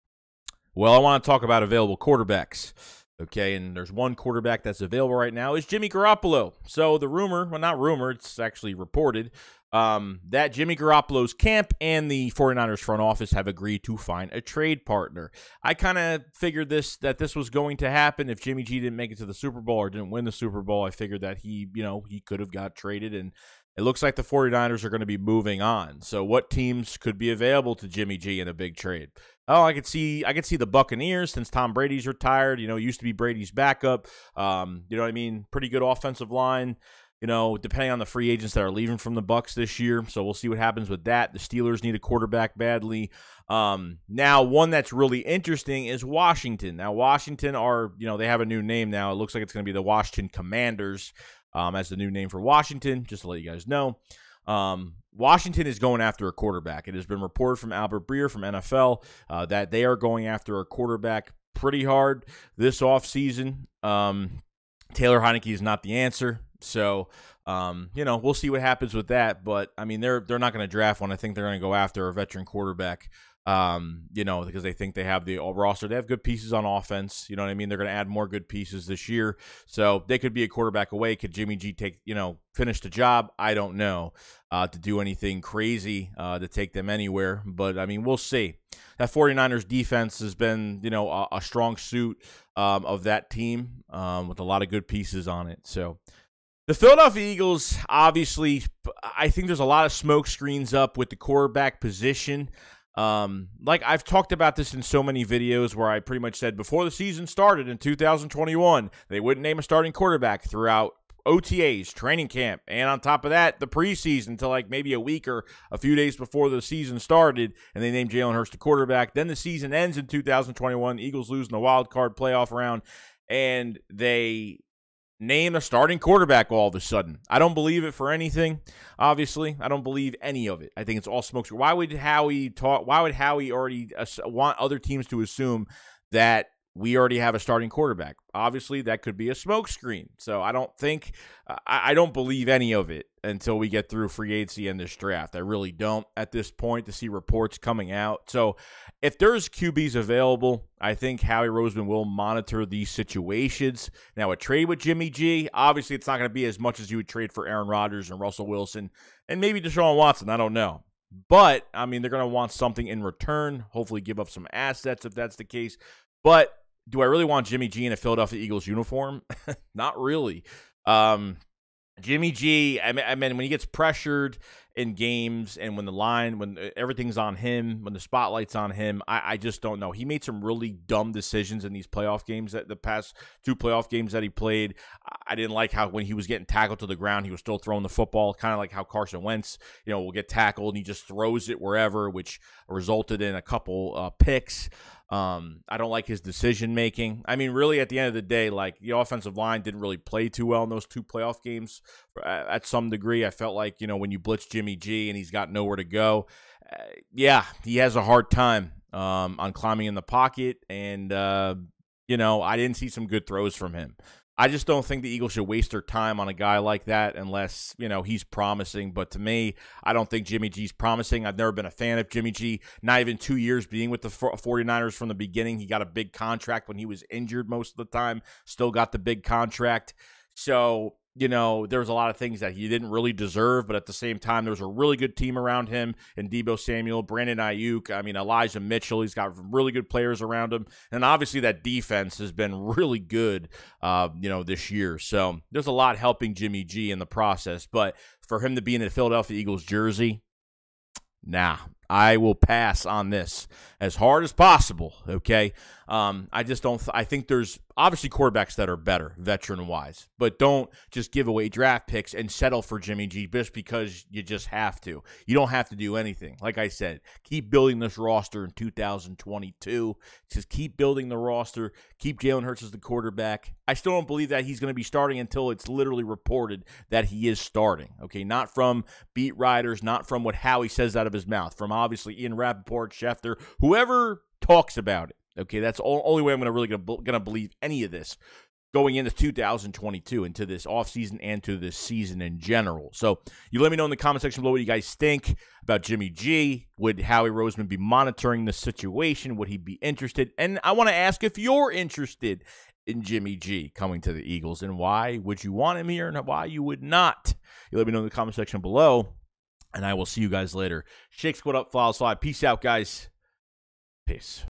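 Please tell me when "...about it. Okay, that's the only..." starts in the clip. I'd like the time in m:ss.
4:44.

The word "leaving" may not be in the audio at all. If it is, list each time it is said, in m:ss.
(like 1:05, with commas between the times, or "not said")
0:38.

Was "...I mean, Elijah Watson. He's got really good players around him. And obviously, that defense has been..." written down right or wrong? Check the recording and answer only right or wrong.
wrong.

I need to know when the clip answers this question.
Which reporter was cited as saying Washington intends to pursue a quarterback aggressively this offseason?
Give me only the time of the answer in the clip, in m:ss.
0:57.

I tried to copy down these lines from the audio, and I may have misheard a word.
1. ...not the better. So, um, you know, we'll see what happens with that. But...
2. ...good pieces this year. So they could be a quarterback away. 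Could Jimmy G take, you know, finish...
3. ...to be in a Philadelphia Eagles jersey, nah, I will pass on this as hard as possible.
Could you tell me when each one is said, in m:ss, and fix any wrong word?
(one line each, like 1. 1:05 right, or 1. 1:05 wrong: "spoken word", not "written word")
1. 1:05 wrong: "answer", not "better"
2. 1:18 right
3. 4:08 right.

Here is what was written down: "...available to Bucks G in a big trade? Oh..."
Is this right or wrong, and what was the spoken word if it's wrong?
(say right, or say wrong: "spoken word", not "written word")
wrong: "Jimmy", not "Bucks".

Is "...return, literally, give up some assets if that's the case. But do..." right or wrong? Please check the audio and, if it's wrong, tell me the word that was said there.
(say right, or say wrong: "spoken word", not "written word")
wrong: "hopefully", not "literally".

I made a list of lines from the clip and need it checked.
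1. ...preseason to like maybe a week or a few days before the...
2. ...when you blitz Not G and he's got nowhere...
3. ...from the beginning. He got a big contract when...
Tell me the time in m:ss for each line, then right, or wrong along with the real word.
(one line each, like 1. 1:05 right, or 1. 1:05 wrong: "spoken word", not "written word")
1. 1:53 right
2. 3:23 wrong: "Jimmy", not "Not"
3. 3:44 right.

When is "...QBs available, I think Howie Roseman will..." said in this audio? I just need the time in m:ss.
2:29.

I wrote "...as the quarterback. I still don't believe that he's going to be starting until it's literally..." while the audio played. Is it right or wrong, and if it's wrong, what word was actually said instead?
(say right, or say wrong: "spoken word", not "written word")
right.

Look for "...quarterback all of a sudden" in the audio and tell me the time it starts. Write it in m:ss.
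2:05.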